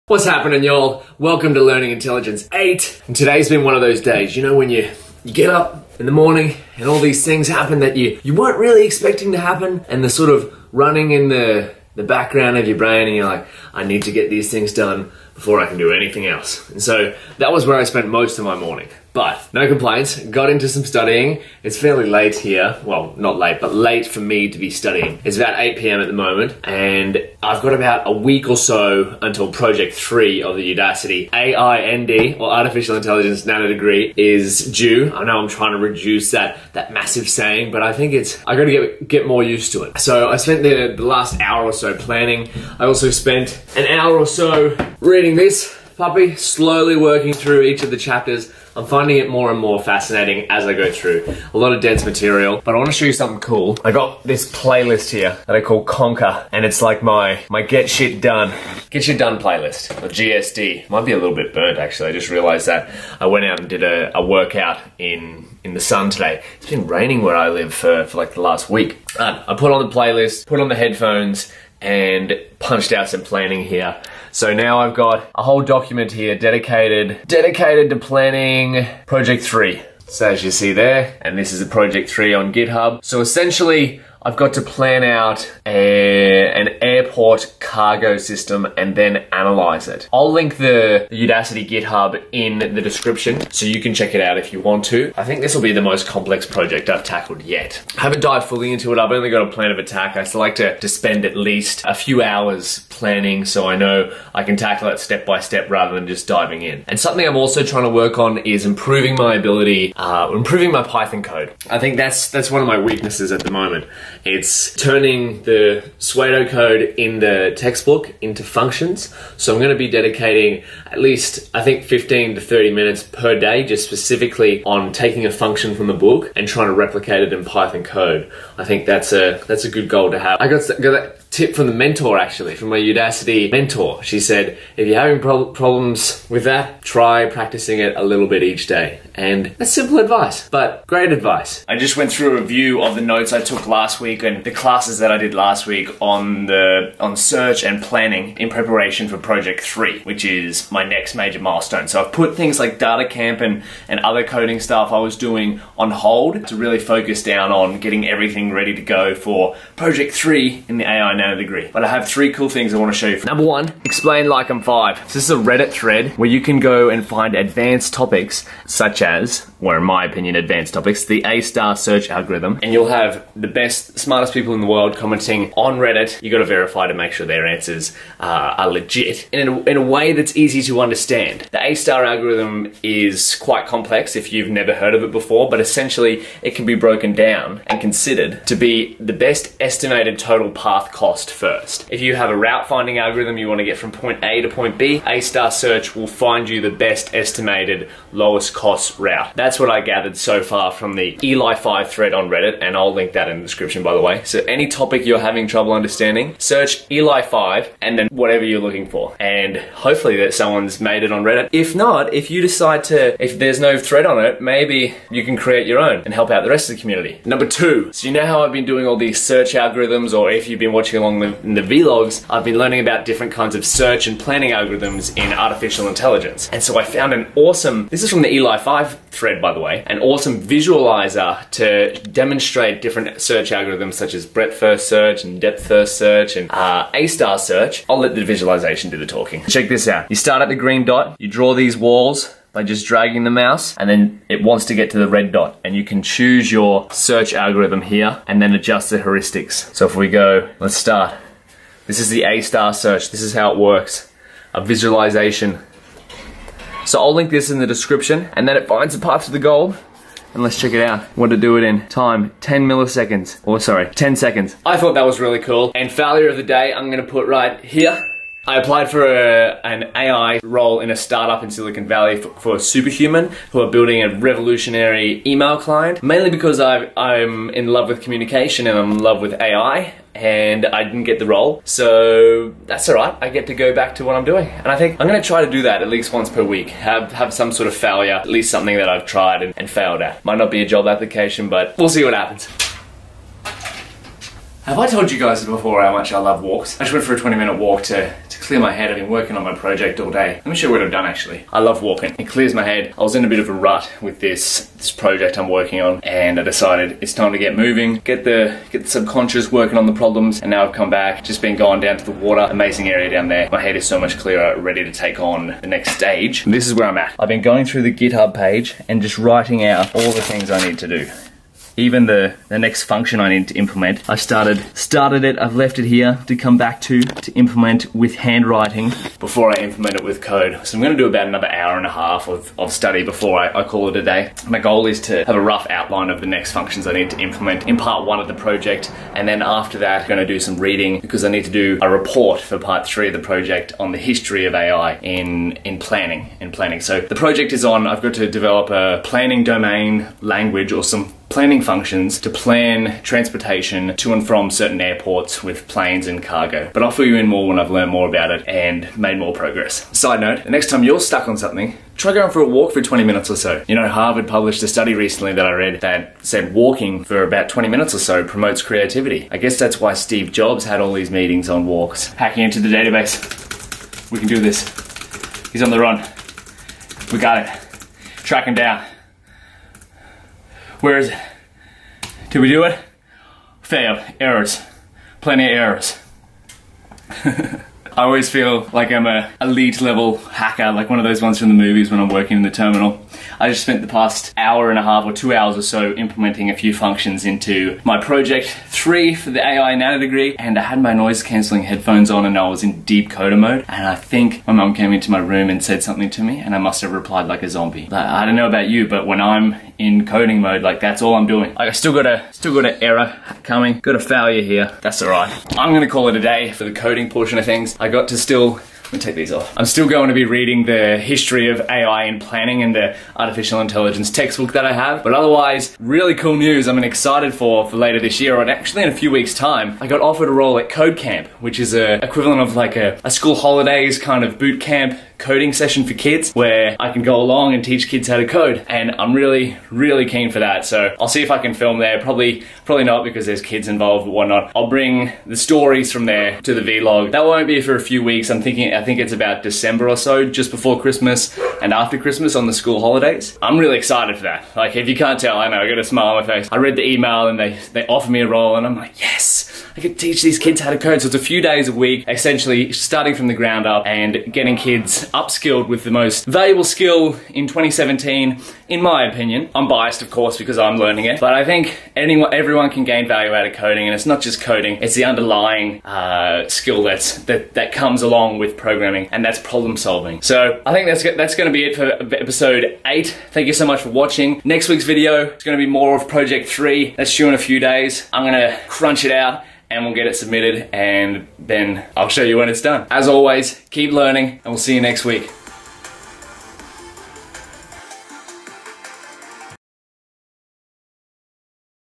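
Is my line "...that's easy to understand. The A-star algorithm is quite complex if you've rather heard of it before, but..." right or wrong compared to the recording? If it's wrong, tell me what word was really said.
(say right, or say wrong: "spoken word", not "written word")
wrong: "never", not "rather".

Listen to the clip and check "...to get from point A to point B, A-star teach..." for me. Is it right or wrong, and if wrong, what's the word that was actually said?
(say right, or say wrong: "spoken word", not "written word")
wrong: "search", not "teach".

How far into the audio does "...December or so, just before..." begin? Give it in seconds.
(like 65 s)
449 s.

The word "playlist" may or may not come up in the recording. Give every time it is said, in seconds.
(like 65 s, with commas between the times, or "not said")
54 s, 59 s, 69 s.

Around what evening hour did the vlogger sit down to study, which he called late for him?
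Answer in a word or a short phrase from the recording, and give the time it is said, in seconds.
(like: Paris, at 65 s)
8 p.m., at 25 s.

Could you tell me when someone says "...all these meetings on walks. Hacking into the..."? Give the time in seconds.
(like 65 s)
370 s.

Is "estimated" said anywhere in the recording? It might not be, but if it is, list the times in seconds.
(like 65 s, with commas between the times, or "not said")
189 s, 197 s.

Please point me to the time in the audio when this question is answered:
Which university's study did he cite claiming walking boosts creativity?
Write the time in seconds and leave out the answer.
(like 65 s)
363 s.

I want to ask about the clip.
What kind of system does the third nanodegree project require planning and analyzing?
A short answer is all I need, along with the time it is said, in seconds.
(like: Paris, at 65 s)
airport cargo system, at 86 s.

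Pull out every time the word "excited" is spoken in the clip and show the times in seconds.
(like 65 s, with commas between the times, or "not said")
426 s, 453 s.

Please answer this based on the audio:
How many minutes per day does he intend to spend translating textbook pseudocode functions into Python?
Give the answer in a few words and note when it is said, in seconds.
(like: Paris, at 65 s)
15 to 30, at 121 s.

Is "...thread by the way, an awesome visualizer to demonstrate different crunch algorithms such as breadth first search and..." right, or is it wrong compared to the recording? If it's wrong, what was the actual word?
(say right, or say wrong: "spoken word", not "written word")
wrong: "search", not "crunch".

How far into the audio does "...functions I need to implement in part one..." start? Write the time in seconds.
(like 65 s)
336 s.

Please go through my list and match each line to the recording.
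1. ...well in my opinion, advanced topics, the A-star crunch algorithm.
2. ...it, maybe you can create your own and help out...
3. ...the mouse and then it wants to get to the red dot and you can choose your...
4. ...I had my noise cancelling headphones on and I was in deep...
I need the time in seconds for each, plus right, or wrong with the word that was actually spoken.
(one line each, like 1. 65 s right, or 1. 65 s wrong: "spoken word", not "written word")
1. 169 s wrong: "search", not "crunch"
2. 214 s right
3. 243 s right
4. 400 s right.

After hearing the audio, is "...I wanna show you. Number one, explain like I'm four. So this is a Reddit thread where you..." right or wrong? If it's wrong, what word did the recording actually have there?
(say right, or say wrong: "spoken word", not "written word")
wrong: "five", not "four".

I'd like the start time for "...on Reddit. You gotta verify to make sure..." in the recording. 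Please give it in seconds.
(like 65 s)
175 s.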